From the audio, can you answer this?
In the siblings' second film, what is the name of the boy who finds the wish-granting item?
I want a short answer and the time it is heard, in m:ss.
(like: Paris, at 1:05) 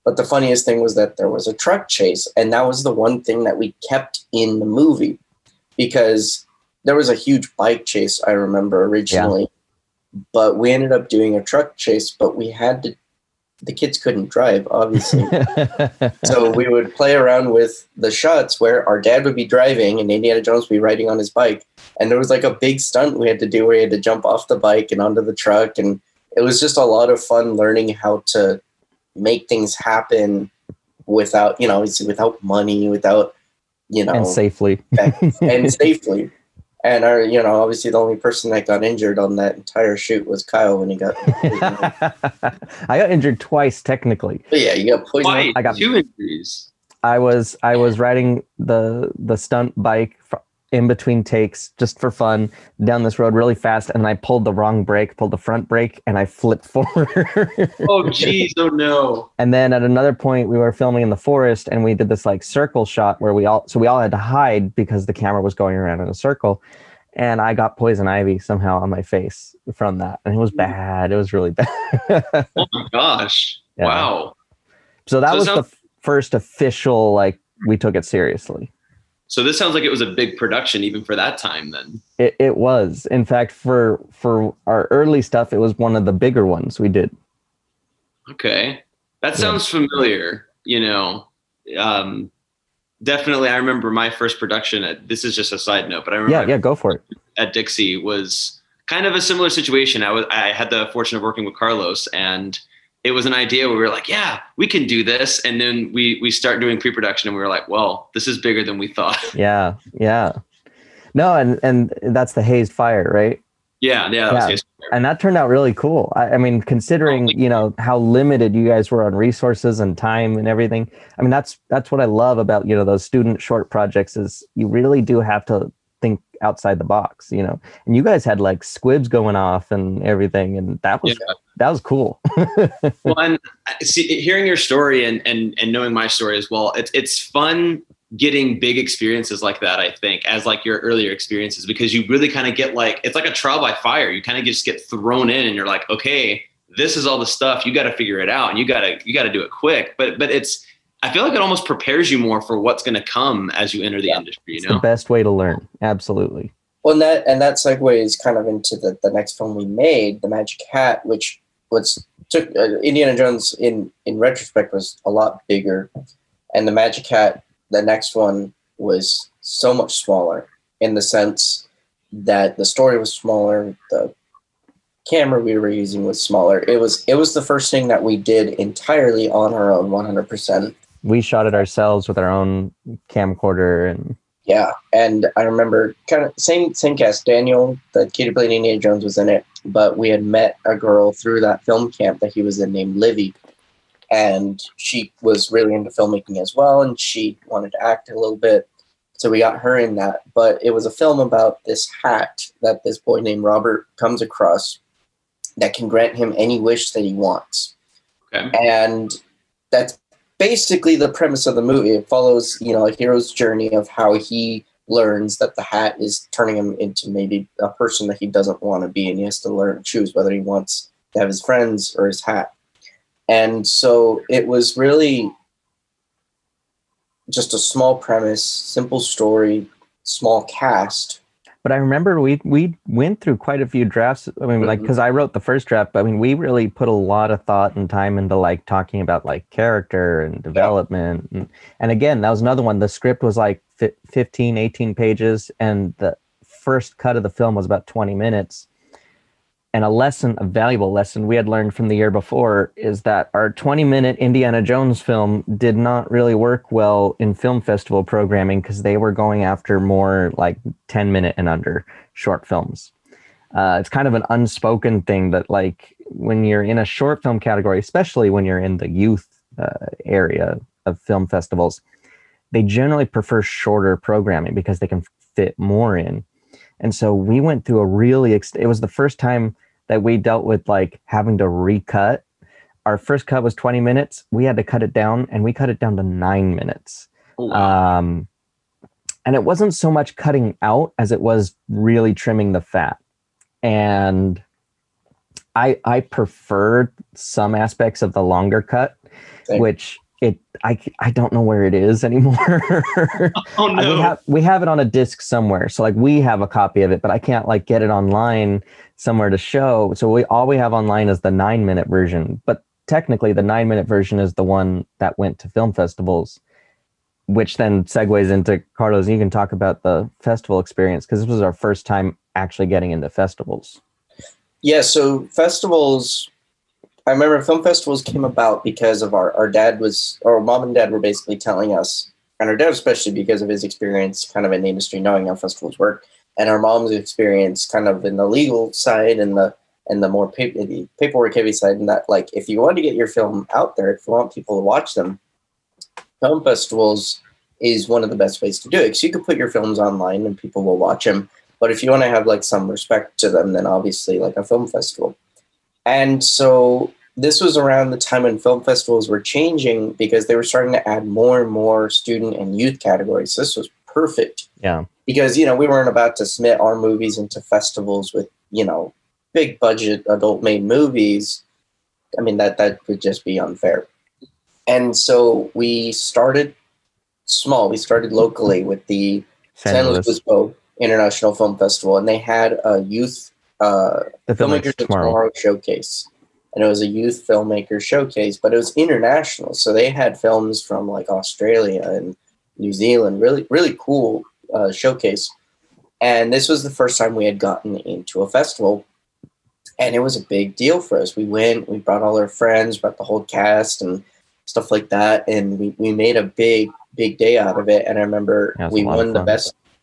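Robert, at 3:23.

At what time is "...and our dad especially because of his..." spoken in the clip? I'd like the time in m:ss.
5:32.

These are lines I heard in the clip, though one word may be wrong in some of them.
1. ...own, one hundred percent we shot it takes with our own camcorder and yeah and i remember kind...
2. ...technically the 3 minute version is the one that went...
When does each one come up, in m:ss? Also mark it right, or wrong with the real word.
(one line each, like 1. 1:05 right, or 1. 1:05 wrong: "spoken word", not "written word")
1. 2:59 wrong: "ourselves", not "takes"
2. 5:12 wrong: "9", not "3".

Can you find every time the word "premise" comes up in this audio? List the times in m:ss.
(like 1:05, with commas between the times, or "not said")
3:31, 3:47.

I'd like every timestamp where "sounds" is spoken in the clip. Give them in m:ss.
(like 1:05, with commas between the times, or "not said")
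1:15, 1:19, 1:29.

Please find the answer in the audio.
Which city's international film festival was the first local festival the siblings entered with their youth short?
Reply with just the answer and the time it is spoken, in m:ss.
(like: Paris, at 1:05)
San Luis Obispo, at 6:19.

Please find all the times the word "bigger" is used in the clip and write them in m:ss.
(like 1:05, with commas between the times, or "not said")
1:26, 1:48, 2:45.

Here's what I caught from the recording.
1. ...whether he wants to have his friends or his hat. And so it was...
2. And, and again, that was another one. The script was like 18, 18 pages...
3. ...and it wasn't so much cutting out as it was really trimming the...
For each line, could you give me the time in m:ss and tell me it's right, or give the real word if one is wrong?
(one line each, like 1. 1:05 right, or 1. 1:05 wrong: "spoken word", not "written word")
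1. 3:40 right
2. 4:01 wrong: "15", not "18"
3. 4:49 right.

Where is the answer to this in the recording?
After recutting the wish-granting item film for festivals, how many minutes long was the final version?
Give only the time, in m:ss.
4:46.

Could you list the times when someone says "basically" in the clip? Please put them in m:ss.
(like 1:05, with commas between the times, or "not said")
3:30, 5:30.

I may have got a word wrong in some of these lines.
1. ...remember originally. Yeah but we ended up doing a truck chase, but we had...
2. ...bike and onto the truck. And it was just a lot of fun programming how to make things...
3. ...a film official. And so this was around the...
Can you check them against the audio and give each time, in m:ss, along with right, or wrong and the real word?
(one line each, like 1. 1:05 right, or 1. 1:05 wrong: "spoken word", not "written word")
1. 0:08 right
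2. 0:24 wrong: "learning", not "programming"
3. 5:54 wrong: "festival", not "official".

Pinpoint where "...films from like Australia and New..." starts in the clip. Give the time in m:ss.
6:30.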